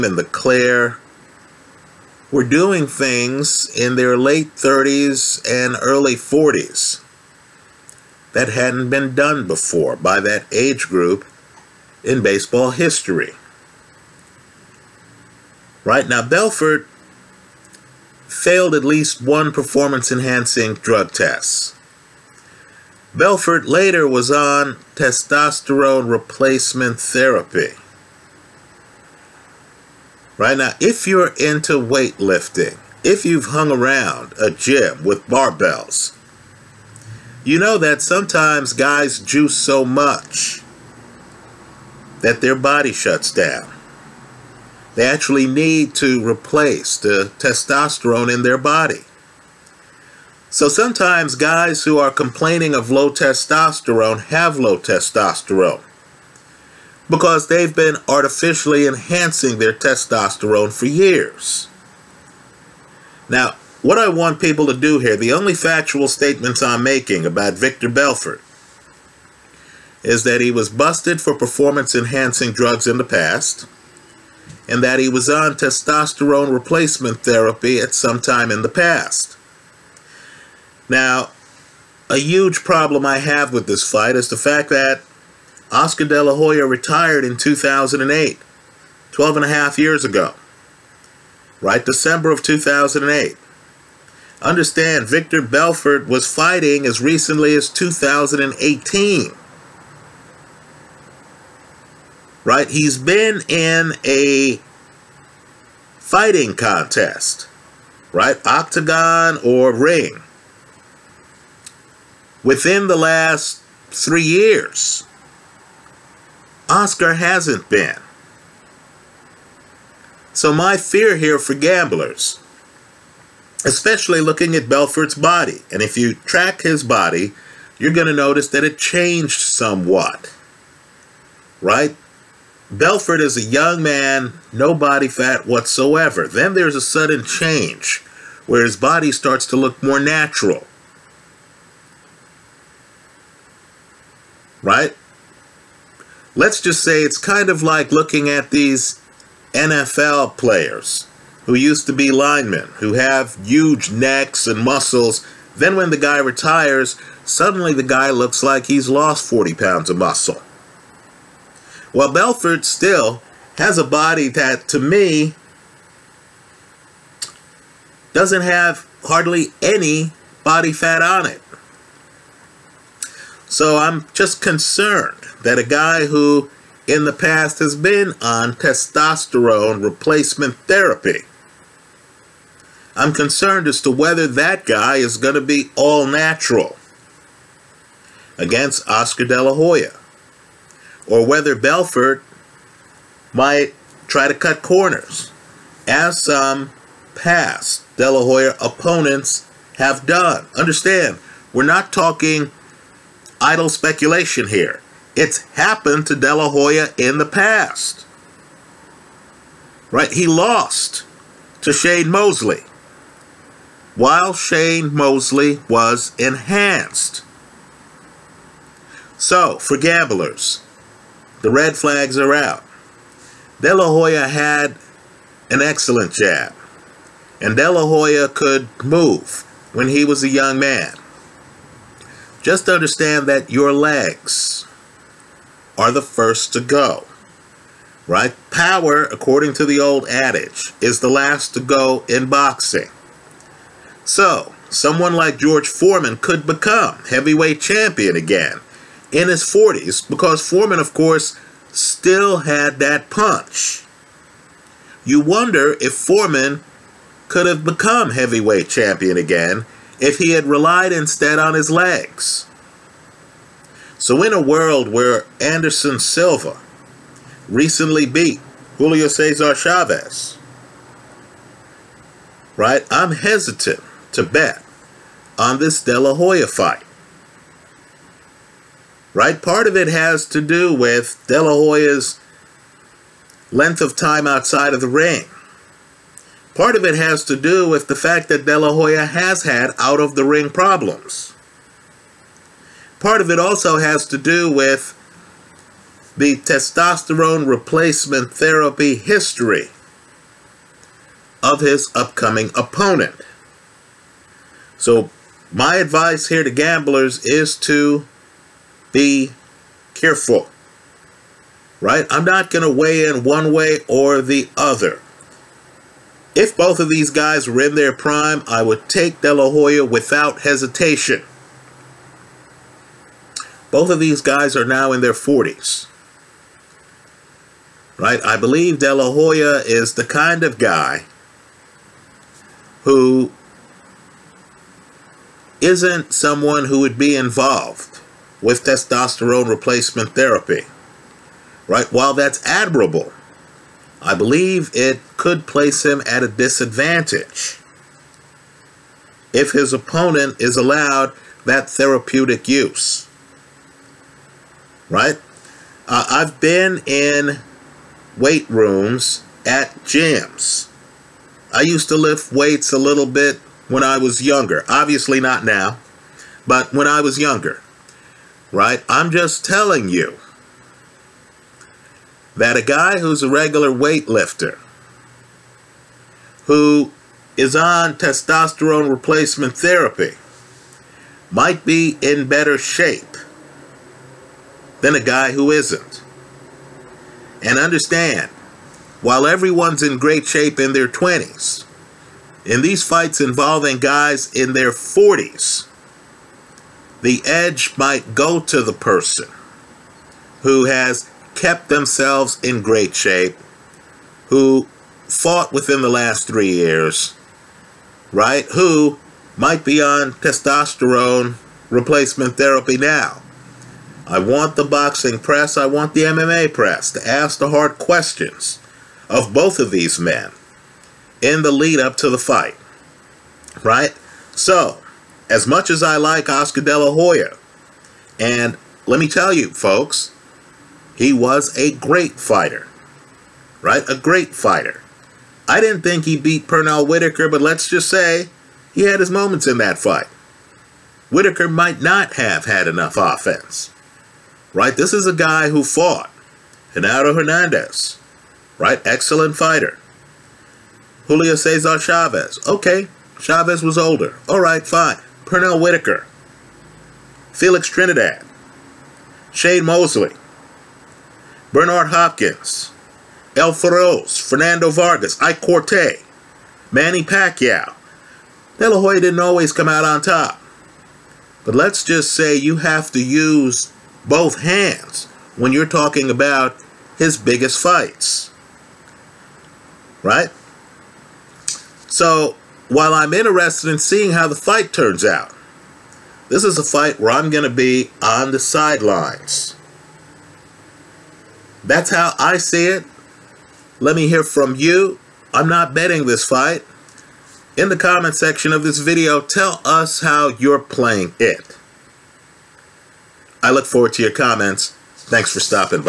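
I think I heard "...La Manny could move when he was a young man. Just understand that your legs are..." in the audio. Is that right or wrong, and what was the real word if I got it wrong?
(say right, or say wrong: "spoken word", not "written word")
wrong: "Hoya", not "Manny".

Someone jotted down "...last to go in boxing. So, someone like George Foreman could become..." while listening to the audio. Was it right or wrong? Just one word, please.
right.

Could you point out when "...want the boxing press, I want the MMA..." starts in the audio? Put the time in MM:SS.
06:54.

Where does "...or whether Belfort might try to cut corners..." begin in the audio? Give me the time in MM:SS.
03:11.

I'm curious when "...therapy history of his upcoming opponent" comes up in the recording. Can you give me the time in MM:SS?
04:58.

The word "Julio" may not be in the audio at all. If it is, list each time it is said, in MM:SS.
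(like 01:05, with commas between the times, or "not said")
04:28, 07:31.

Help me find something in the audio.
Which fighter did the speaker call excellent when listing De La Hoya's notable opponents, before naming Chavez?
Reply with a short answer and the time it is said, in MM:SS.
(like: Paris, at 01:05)
Genaro Hernandez, at 07:26.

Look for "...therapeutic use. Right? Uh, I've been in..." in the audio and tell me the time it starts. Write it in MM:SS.
05:51.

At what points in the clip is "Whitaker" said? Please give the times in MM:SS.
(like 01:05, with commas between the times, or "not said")
07:16, 07:21, 07:35.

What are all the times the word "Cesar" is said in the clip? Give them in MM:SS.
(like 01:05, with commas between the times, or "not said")
04:29, 07:31.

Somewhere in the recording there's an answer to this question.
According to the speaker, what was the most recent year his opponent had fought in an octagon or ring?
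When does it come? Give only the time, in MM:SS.
01:37.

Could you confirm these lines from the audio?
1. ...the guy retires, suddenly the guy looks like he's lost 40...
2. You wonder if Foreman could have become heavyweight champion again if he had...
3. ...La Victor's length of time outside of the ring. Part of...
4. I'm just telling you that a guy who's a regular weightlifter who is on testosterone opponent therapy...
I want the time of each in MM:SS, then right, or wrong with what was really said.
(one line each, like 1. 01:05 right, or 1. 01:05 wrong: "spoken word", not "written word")
1. 02:35 right
2. 04:15 right
3. 04:41 wrong: "Hoya", not "Victor"
4. 06:08 wrong: "replacement", not "opponent".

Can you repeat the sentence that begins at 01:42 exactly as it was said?
He's been in a fighting contest, right?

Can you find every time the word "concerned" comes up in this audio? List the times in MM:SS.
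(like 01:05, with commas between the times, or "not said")
02:54, 03:03.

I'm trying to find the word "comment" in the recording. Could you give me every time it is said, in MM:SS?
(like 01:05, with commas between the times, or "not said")
08:17, 08:24.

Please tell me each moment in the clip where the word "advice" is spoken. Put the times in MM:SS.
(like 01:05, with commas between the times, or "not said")
05:05.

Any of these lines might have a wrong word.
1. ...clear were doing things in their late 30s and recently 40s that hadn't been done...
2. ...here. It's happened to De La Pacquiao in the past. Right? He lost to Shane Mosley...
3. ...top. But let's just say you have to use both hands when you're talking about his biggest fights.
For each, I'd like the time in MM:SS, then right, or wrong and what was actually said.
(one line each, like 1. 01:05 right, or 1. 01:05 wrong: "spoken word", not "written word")
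1. 00:00 wrong: "early", not "recently"
2. 03:24 wrong: "Hoya", not "Pacquiao"
3. 07:50 right.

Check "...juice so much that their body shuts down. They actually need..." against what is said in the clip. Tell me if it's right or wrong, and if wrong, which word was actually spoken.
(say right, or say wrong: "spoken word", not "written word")
right.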